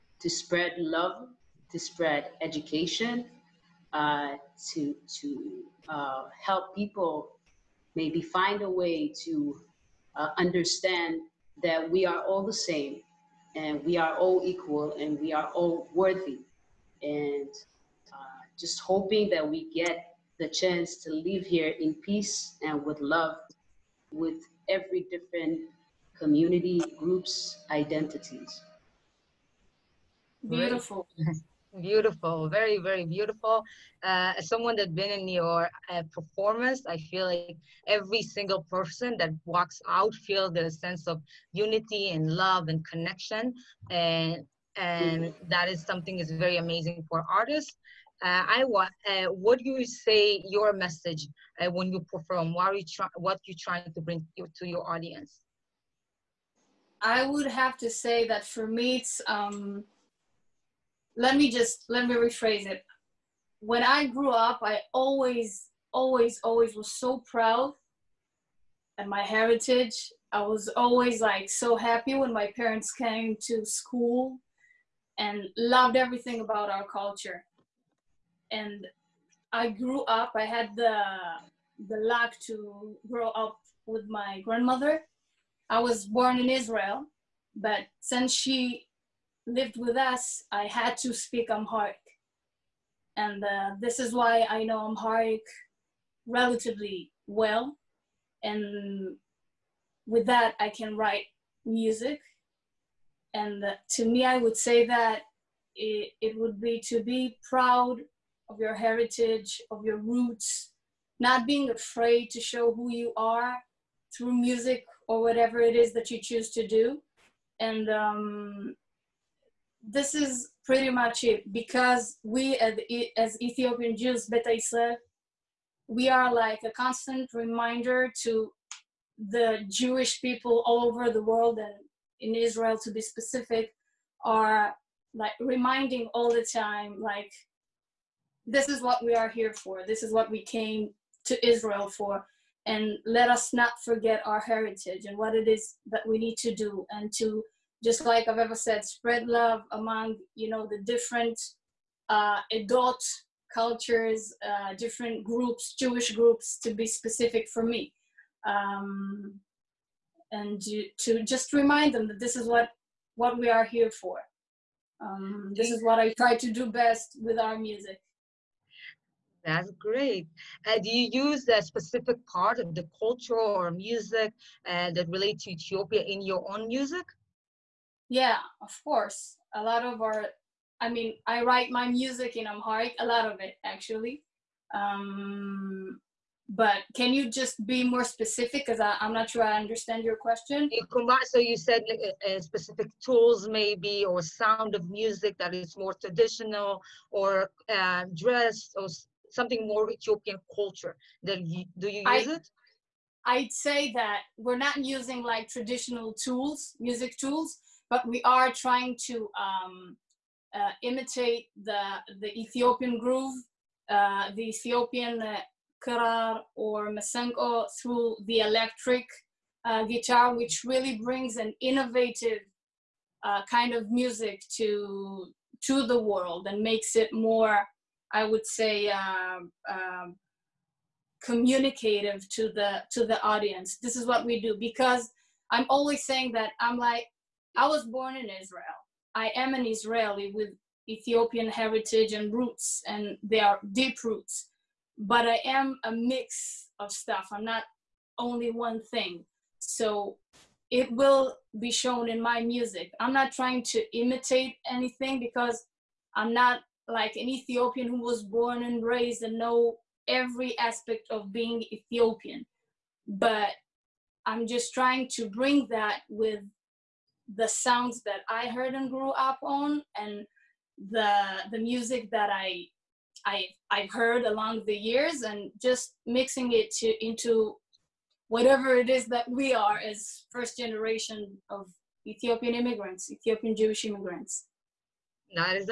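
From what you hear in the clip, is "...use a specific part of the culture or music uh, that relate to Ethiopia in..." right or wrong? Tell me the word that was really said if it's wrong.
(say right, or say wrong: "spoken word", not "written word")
right.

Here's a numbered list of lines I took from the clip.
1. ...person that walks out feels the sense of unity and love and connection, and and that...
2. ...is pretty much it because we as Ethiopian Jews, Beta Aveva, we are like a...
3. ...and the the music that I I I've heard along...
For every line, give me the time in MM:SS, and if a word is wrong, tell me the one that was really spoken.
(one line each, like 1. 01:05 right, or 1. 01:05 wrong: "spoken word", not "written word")
1. 00:38 right
2. 02:00 wrong: "Israel", not "Aveva"
3. 04:29 right.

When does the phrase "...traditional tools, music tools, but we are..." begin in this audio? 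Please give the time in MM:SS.
03:25.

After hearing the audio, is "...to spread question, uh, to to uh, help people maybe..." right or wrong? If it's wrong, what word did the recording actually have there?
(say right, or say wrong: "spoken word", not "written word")
wrong: "education", not "question".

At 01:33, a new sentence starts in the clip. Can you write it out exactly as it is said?
And uh, this is why I know Amharic relatively well.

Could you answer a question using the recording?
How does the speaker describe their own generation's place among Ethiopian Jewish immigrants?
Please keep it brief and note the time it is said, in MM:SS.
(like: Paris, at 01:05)
first generation, at 04:40.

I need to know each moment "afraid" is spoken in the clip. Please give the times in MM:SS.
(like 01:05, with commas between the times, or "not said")
01:51.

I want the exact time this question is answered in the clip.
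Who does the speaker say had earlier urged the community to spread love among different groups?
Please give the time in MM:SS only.
02:28.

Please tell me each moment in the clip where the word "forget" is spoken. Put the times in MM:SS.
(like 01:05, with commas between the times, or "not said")
02:23.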